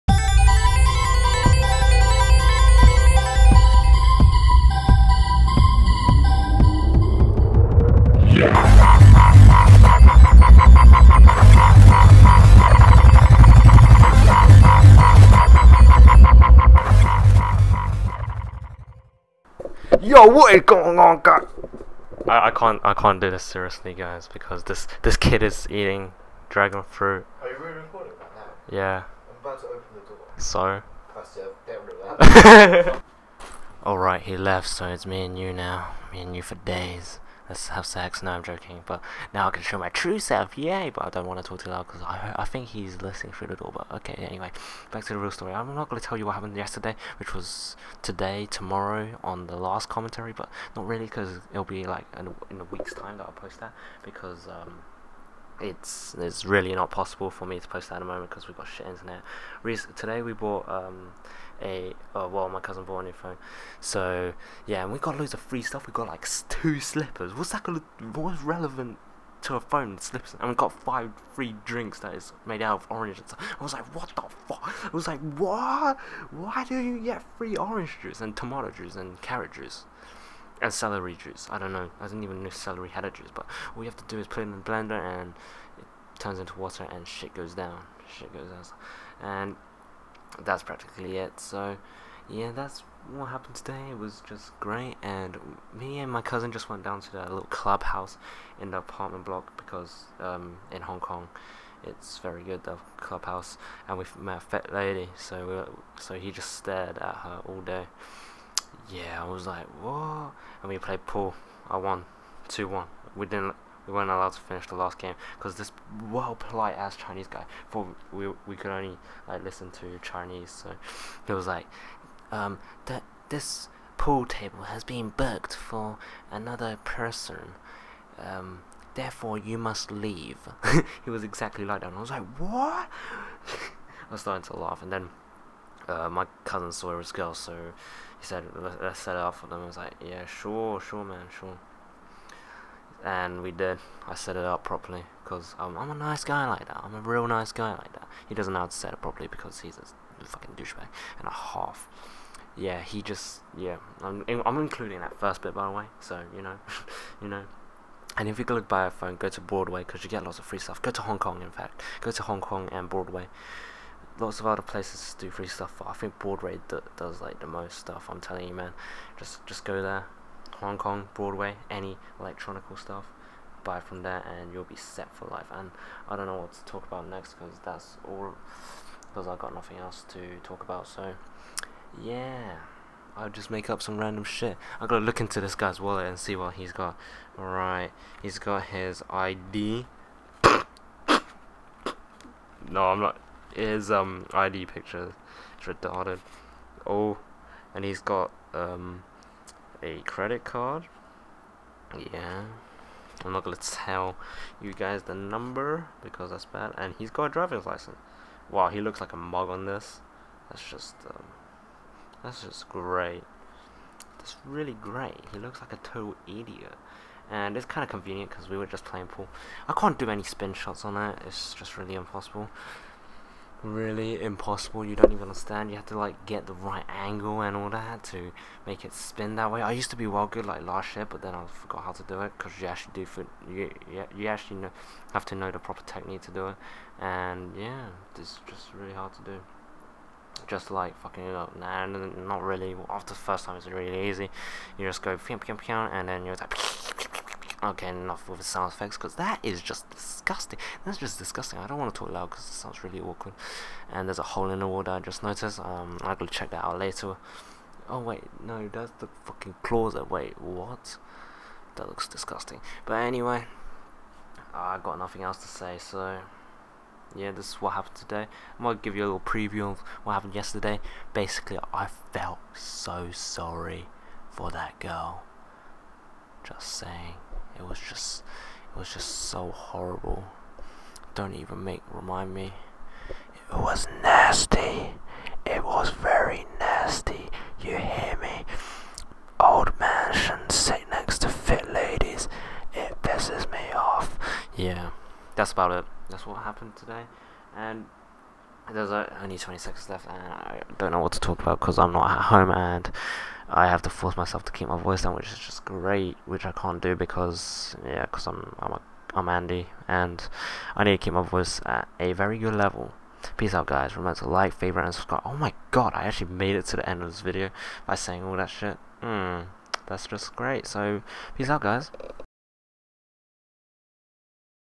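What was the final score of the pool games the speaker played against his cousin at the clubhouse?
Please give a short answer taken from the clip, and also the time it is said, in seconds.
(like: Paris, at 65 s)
2-1, at 112 s.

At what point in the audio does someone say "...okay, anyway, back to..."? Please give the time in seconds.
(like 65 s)
43 s.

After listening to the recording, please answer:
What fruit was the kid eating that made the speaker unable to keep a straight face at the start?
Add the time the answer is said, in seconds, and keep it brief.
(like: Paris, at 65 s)
dragon fruit, at 26 s.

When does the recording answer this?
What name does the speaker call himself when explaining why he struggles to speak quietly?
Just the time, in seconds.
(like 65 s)
309 s.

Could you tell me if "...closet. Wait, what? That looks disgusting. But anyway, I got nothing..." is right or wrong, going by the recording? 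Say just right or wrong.
right.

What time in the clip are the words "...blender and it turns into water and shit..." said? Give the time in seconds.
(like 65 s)
84 s.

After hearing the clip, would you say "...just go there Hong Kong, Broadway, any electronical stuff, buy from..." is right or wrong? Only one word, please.
right.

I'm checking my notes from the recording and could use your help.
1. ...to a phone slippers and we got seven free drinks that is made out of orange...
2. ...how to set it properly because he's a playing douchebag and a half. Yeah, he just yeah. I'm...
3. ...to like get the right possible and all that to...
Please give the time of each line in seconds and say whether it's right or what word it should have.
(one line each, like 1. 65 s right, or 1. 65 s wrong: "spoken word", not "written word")
1. 69 s wrong: "five", not "seven"
2. 148 s wrong: "fucking", not "playing"
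3. 225 s wrong: "angle", not "possible".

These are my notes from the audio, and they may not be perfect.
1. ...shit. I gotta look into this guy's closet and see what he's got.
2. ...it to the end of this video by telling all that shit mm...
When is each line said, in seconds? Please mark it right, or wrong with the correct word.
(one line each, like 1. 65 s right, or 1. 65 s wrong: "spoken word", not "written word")
1. 184 s wrong: "wallet", not "closet"
2. 316 s wrong: "saying", not "telling".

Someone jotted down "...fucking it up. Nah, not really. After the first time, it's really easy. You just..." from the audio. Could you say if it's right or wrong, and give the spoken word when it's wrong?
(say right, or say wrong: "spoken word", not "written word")
right.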